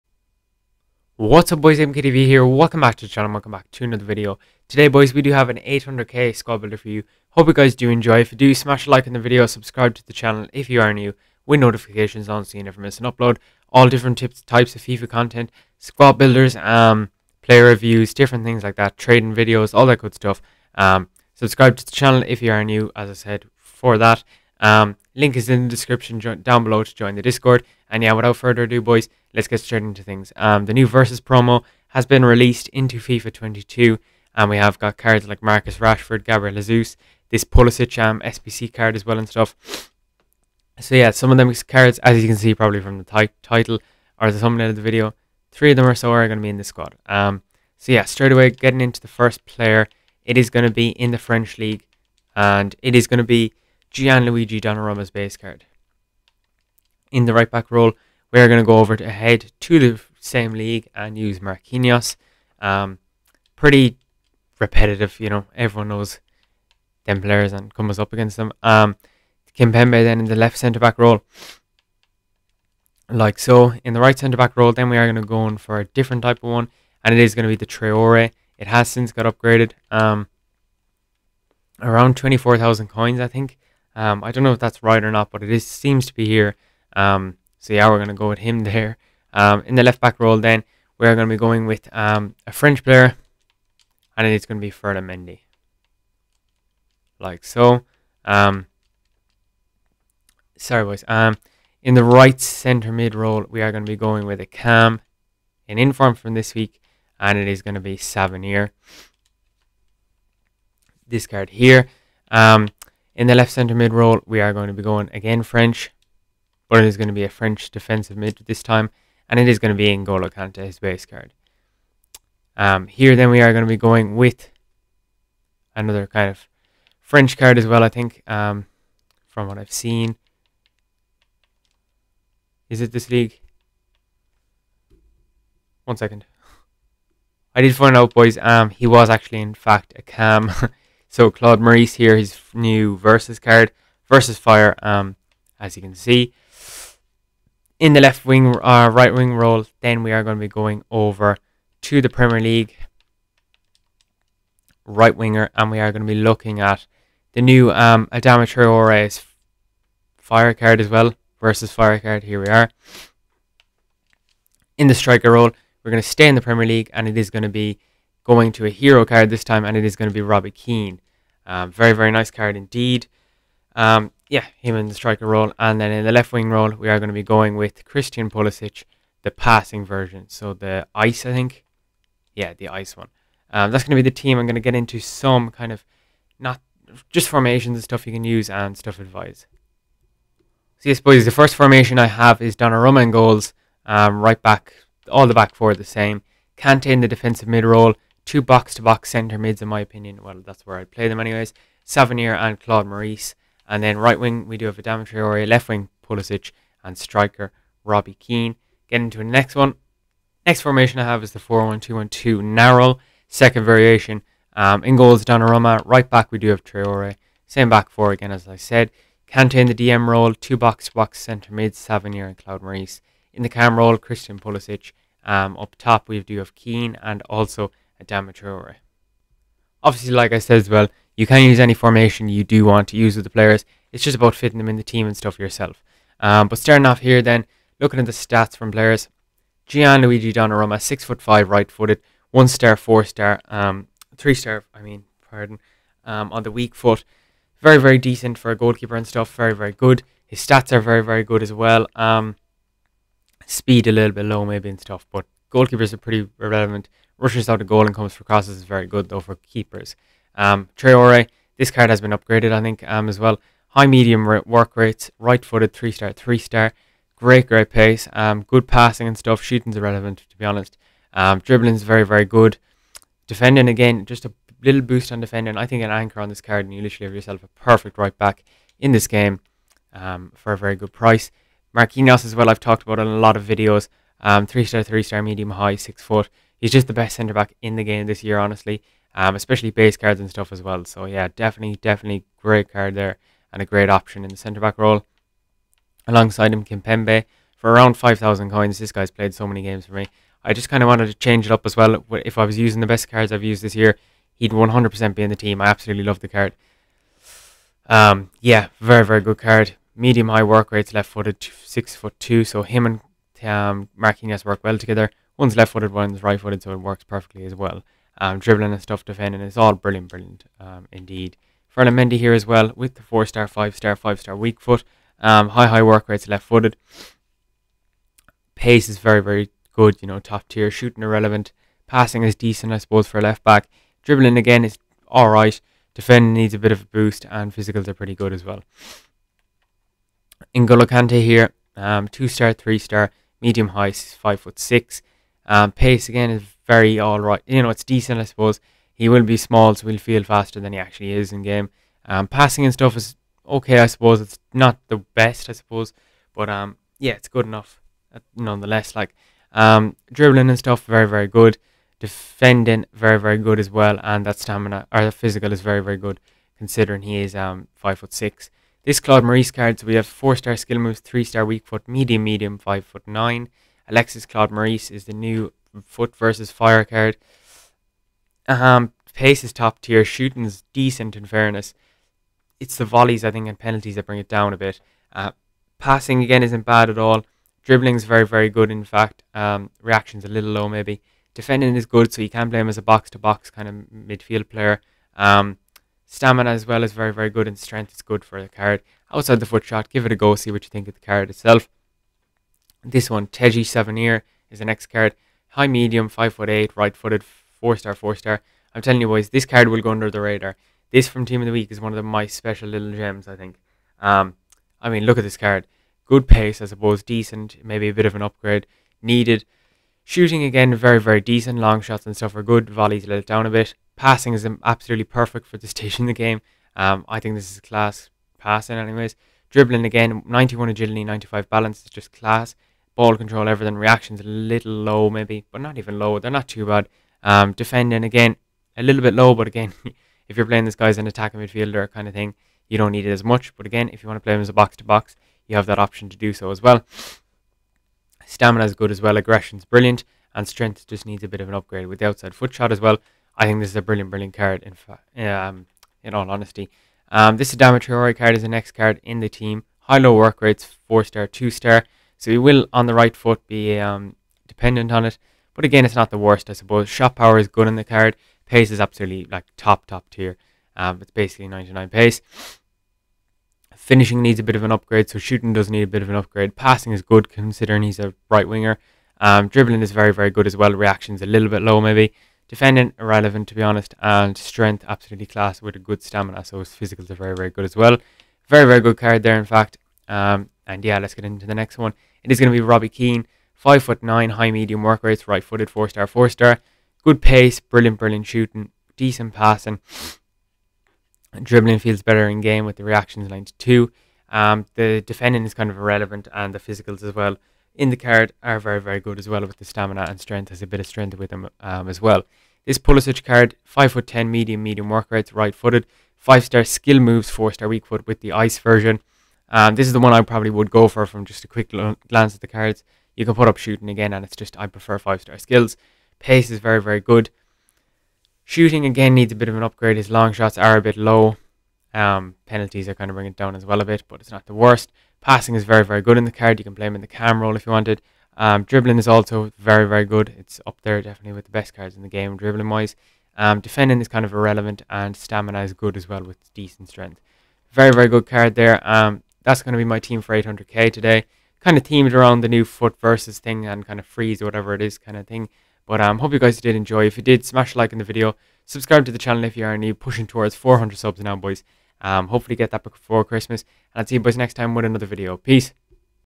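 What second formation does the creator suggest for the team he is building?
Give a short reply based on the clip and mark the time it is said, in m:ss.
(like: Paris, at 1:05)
4-1-2-1-2 narrow, at 3:31.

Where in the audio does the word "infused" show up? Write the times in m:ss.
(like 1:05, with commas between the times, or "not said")
not said.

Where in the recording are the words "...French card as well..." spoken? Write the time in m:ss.
2:06.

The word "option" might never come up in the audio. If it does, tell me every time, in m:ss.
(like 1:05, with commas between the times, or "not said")
4:53, 7:25.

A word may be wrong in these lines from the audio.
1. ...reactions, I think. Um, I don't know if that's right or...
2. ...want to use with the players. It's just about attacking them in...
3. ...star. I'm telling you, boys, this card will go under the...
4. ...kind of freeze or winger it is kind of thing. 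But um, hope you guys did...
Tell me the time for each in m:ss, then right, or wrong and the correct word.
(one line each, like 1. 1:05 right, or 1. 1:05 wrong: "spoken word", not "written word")
1. 1:22 wrong: "coins", not "reactions"
2. 3:52 wrong: "fitting", not "attacking"
3. 6:48 right
4. 9:13 wrong: "whatever", not "winger".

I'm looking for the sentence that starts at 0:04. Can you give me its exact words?
Today boys, we do have an 800k squad builder for you.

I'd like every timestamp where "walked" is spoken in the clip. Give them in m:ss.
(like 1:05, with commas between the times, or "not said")
not said.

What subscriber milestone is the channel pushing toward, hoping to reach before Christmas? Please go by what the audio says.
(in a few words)
400.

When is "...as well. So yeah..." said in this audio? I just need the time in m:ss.
4:50.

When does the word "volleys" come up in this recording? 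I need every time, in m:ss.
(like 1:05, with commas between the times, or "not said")
6:22, 7:02.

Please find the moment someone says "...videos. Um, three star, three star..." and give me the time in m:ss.
4:43.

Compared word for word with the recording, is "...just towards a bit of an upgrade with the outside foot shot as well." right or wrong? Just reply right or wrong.
wrong.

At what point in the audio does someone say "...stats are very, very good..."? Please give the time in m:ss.
4:10.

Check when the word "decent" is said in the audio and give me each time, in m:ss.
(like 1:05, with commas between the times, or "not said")
4:07, 5:32, 5:47, 6:20, 6:57, 7:01, 8:18, 9:06.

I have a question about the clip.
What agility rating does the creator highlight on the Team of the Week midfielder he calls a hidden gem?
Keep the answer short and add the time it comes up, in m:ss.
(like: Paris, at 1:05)
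91, at 7:10.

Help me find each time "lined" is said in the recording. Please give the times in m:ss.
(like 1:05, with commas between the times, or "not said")
8:23.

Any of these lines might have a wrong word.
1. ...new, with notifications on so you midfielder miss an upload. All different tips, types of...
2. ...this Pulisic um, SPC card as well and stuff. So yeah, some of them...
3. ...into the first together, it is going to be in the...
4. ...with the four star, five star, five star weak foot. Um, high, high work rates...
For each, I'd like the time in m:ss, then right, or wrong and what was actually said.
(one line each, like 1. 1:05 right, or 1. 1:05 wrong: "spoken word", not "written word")
1. 0:10 wrong: "never", not "midfielder"
2. 0:37 right
3. 0:48 wrong: "player", not "together"
4. 5:22 right.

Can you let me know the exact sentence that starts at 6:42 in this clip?
This one, Teji Savanier, is the next card.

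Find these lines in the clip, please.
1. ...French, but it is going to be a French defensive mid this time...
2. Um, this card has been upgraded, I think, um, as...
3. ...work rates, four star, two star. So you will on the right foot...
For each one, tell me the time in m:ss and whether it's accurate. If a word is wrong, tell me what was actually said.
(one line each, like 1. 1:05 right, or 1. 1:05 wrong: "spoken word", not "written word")
1. 1:55 right
2. 4:20 right
3. 7:40 right.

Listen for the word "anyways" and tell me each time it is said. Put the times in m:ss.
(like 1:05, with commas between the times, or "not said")
3:21, 7:08.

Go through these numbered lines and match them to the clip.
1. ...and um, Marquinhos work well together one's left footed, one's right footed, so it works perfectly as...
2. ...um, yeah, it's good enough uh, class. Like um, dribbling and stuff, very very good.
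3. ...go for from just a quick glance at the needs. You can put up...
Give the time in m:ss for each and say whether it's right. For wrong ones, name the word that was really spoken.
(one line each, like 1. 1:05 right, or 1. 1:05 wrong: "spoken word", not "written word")
1. 5:12 right
2. 5:56 wrong: "nonetheless", not "class"
3. 8:40 wrong: "cards", not "needs".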